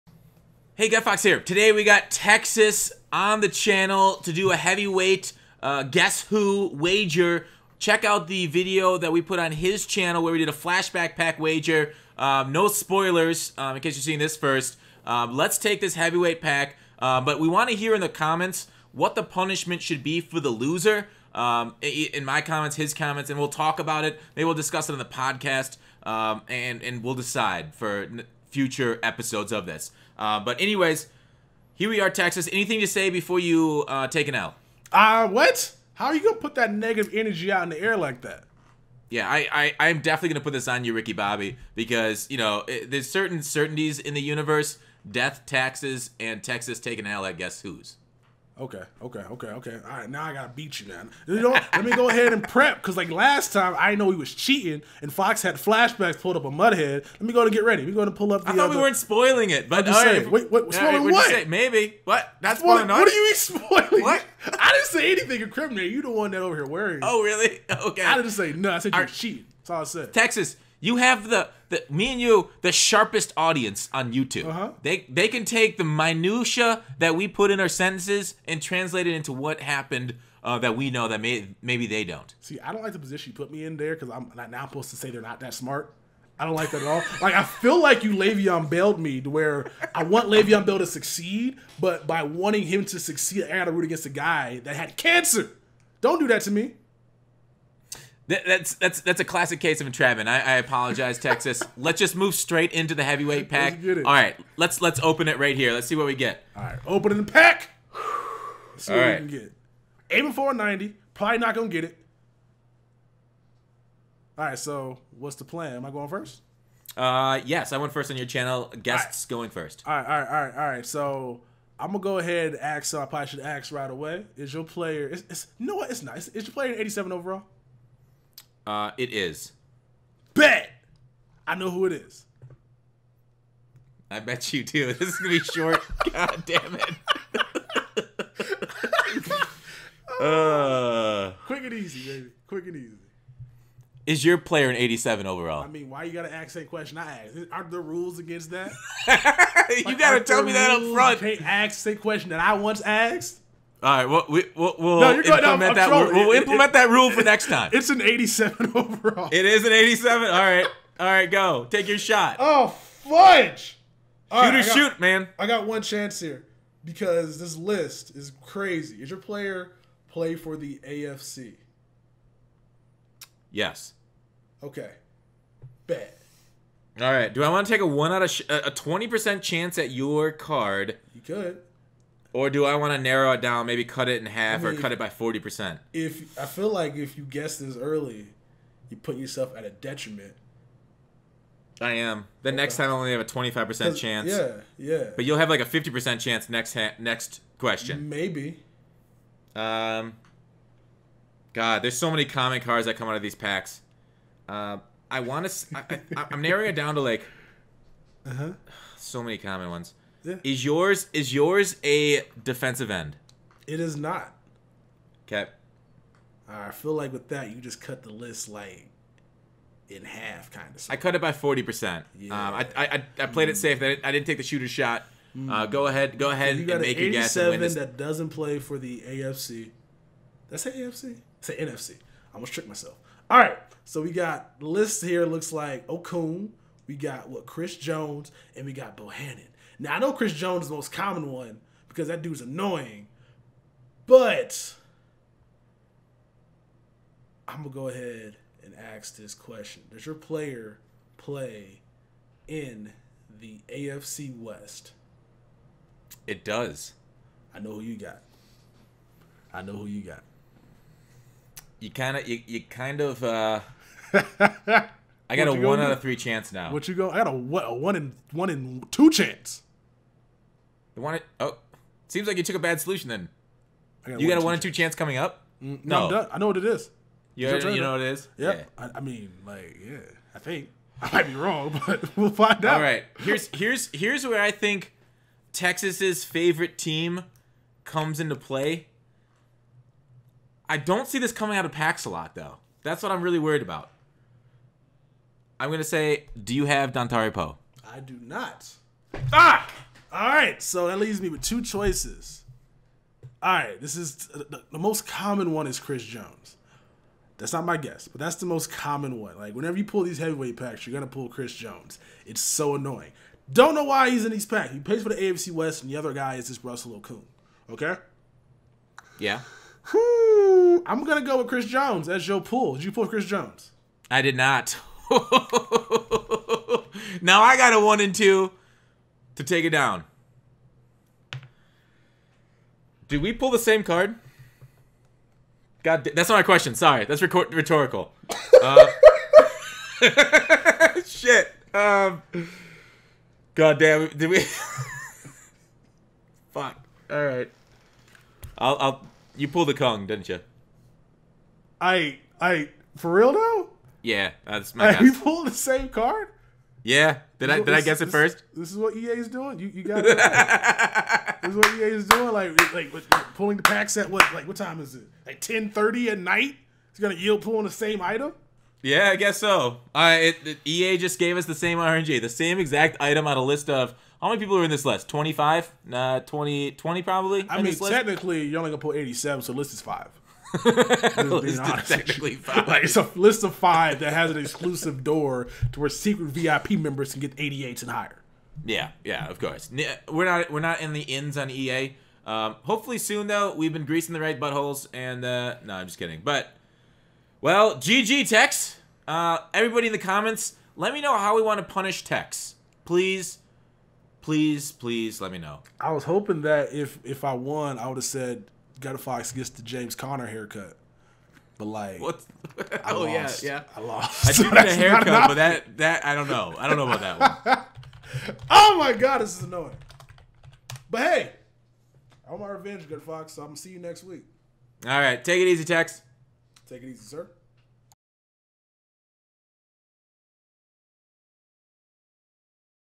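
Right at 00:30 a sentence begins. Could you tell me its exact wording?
Uh, but anyways, here we are, Texas.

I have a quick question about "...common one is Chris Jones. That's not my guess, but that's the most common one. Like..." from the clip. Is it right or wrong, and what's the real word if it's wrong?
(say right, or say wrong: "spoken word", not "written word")
right.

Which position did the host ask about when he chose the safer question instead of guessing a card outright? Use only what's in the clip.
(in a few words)
Defensive end.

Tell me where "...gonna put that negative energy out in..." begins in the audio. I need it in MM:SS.
00:36.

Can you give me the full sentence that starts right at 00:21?
Um, in my comments, his comments, and we'll talk about it.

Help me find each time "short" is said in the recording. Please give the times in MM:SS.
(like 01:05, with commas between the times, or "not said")
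02:15.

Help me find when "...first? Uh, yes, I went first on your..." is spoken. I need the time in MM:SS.
01:56.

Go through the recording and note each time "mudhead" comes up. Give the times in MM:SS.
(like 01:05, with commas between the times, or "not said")
00:56.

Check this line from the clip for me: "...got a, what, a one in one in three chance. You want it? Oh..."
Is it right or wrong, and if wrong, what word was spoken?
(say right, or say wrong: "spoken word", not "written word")
wrong: "two", not "three".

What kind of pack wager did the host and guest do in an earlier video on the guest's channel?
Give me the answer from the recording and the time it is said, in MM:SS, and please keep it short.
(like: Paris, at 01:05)
Flashback pack, at 00:10.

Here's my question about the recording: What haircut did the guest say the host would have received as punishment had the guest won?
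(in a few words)
James Conner haircut.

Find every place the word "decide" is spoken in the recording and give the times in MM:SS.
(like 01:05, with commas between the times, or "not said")
00:27.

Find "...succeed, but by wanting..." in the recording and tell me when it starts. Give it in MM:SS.
01:30.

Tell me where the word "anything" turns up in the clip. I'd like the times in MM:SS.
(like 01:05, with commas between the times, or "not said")
00:32, 01:05.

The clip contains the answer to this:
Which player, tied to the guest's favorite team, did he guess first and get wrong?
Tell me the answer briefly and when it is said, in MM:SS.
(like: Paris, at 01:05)
Dontari Poe, at 04:56.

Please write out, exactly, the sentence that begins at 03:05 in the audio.
If I feel like if you guess this early, you put yourself at a detriment.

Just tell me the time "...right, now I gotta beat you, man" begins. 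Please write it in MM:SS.
00:49.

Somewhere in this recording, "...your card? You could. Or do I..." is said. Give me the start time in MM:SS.
02:59.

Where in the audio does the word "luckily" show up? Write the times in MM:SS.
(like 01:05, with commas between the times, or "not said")
not said.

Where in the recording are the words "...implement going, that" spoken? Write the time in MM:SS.
02:35.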